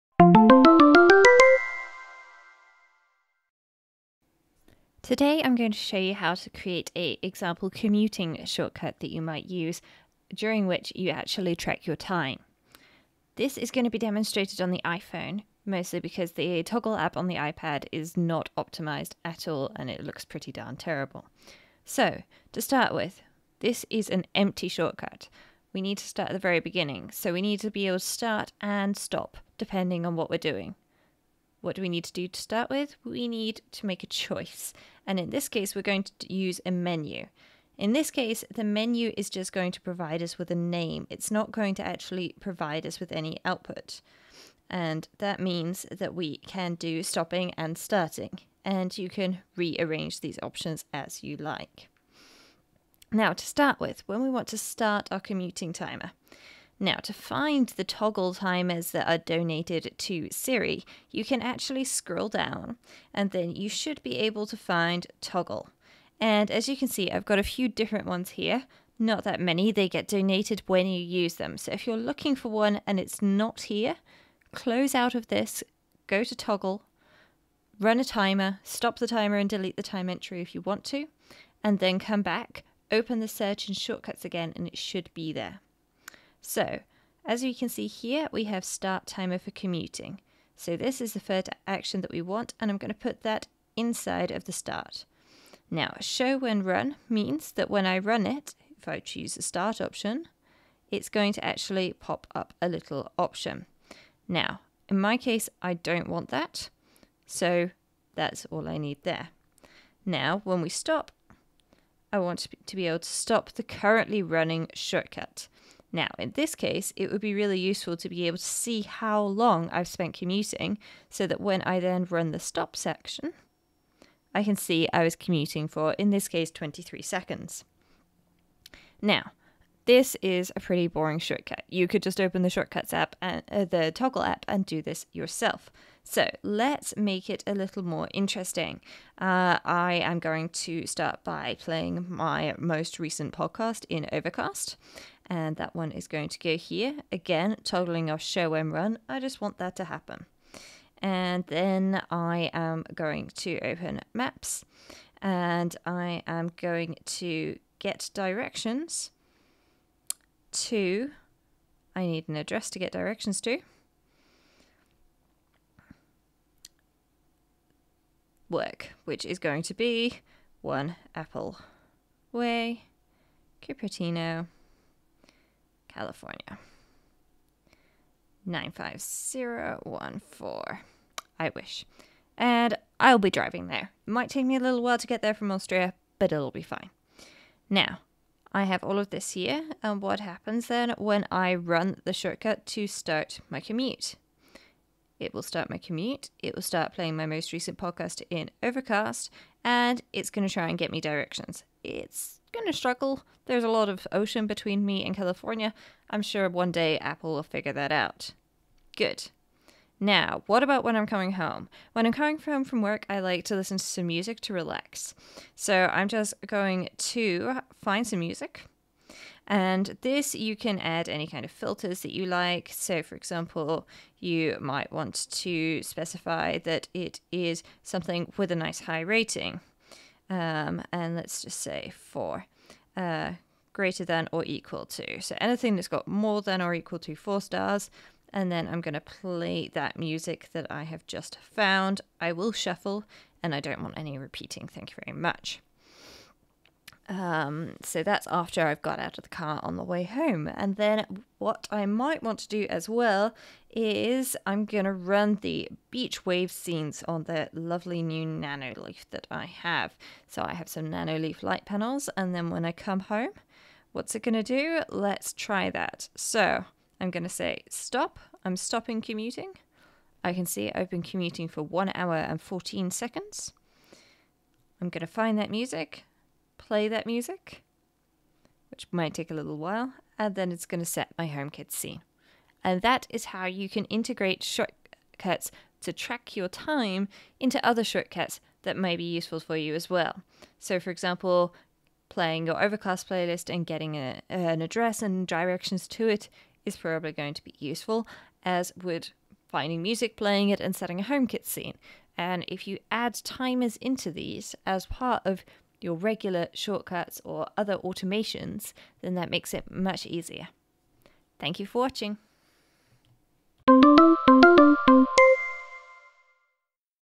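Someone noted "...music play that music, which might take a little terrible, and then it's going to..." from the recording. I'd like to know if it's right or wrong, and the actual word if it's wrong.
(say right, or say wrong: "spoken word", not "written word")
wrong: "while", not "terrible".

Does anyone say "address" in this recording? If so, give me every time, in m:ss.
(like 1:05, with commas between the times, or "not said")
2:42, 4:54.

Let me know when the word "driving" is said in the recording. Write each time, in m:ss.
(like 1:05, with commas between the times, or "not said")
3:03.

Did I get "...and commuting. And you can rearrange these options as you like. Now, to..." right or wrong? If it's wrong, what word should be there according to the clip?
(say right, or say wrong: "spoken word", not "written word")
wrong: "starting", not "commuting".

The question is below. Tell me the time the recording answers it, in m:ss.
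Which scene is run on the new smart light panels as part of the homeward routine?
4:15.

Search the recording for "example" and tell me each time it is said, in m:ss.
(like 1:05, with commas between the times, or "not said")
0:07, 3:43, 4:50.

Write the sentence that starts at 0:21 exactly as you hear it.
So, to start with, this is an empty shortcut.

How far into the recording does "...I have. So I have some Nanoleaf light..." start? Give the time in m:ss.
4:19.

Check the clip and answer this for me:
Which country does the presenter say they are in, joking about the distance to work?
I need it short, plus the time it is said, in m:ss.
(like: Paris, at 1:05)
Austria, at 3:05.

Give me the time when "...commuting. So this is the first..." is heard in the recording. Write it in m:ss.
1:29.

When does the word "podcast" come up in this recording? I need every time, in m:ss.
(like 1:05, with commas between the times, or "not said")
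2:23, 3:17.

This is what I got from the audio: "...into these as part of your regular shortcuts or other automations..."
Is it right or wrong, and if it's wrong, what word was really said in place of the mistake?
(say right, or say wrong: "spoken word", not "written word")
right.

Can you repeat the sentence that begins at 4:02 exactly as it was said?
I will shuffle and I don't want any repeating.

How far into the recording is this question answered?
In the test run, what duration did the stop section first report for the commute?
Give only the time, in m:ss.
2:06.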